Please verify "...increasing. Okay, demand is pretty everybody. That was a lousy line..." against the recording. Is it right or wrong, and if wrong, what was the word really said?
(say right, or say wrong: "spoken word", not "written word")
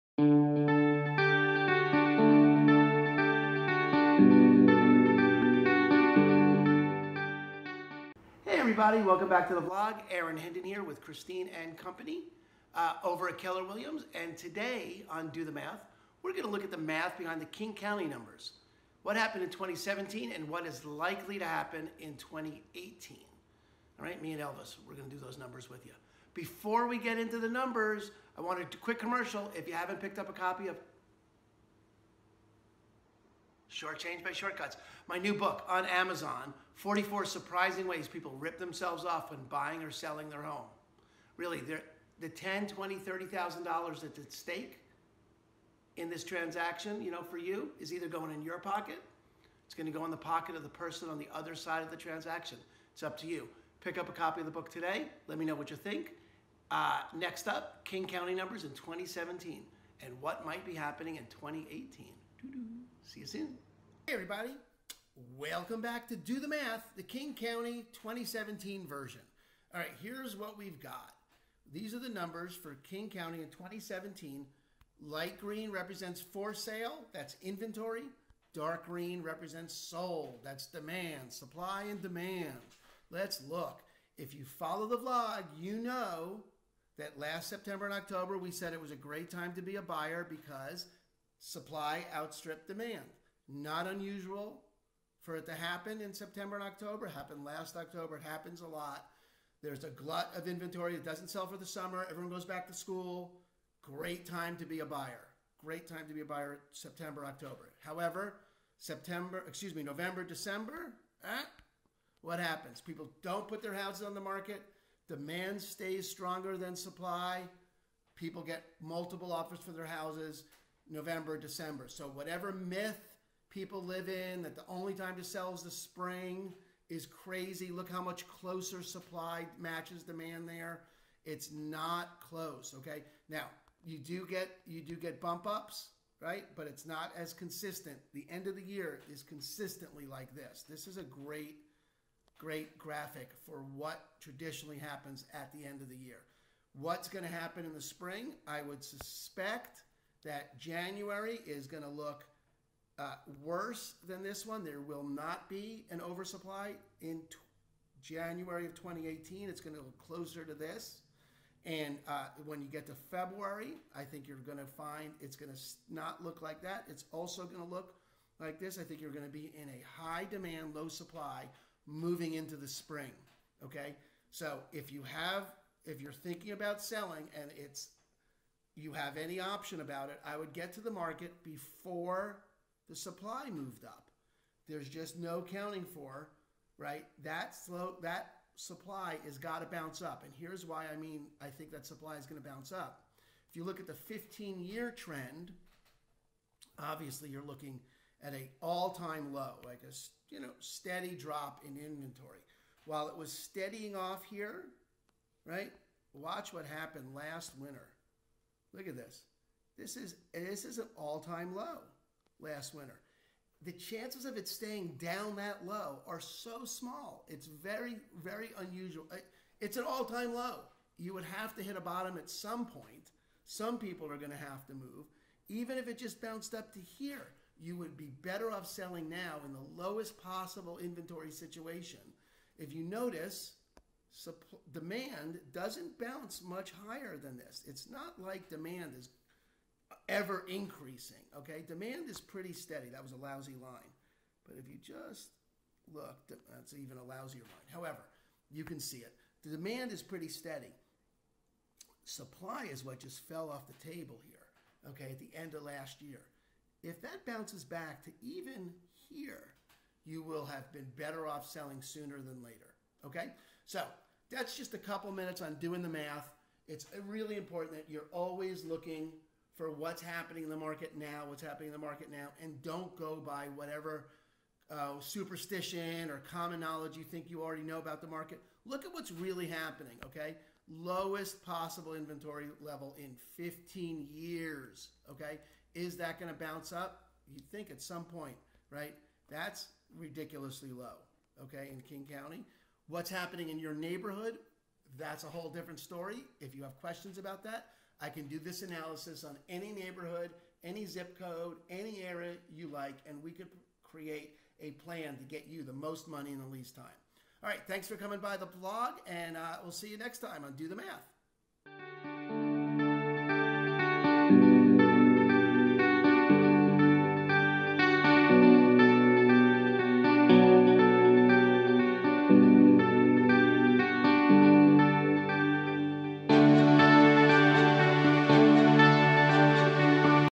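wrong: "steady", not "everybody".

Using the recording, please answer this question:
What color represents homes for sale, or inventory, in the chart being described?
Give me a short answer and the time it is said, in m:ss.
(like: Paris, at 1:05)
Light green, at 1:15.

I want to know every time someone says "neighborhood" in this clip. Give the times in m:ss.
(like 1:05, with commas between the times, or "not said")
4:53, 4:59.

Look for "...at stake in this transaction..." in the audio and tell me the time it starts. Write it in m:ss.
0:44.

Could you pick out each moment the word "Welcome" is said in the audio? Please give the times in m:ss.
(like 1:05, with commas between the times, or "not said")
0:09, 1:05.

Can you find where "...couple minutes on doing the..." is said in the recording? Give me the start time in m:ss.
4:24.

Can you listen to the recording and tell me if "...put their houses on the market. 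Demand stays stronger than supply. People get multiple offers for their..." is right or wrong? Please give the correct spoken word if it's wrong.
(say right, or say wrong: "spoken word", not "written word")
right.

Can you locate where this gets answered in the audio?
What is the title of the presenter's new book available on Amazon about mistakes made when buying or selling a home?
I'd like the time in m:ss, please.
0:33.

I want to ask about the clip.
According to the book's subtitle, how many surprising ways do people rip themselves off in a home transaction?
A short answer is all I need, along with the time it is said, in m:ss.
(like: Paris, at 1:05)
44, at 0:36.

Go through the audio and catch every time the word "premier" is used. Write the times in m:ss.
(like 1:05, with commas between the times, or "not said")
not said.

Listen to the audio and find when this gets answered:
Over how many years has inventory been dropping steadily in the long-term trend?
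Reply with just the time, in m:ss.
3:13.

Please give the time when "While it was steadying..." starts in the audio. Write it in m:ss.
3:22.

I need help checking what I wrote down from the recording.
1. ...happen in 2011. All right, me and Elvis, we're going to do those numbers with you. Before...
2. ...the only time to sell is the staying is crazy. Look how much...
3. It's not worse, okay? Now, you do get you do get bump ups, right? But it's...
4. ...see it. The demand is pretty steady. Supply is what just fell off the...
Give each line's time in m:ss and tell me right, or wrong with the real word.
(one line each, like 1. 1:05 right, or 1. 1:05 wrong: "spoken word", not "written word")
1. 0:21 wrong: "2018", not "2011"
2. 2:04 wrong: "spring", not "staying"
3. 2:11 wrong: "close", not "worse"
4. 4:08 right.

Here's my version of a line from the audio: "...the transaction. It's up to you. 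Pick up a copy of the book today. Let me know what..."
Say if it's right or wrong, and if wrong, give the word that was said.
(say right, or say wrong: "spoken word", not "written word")
right.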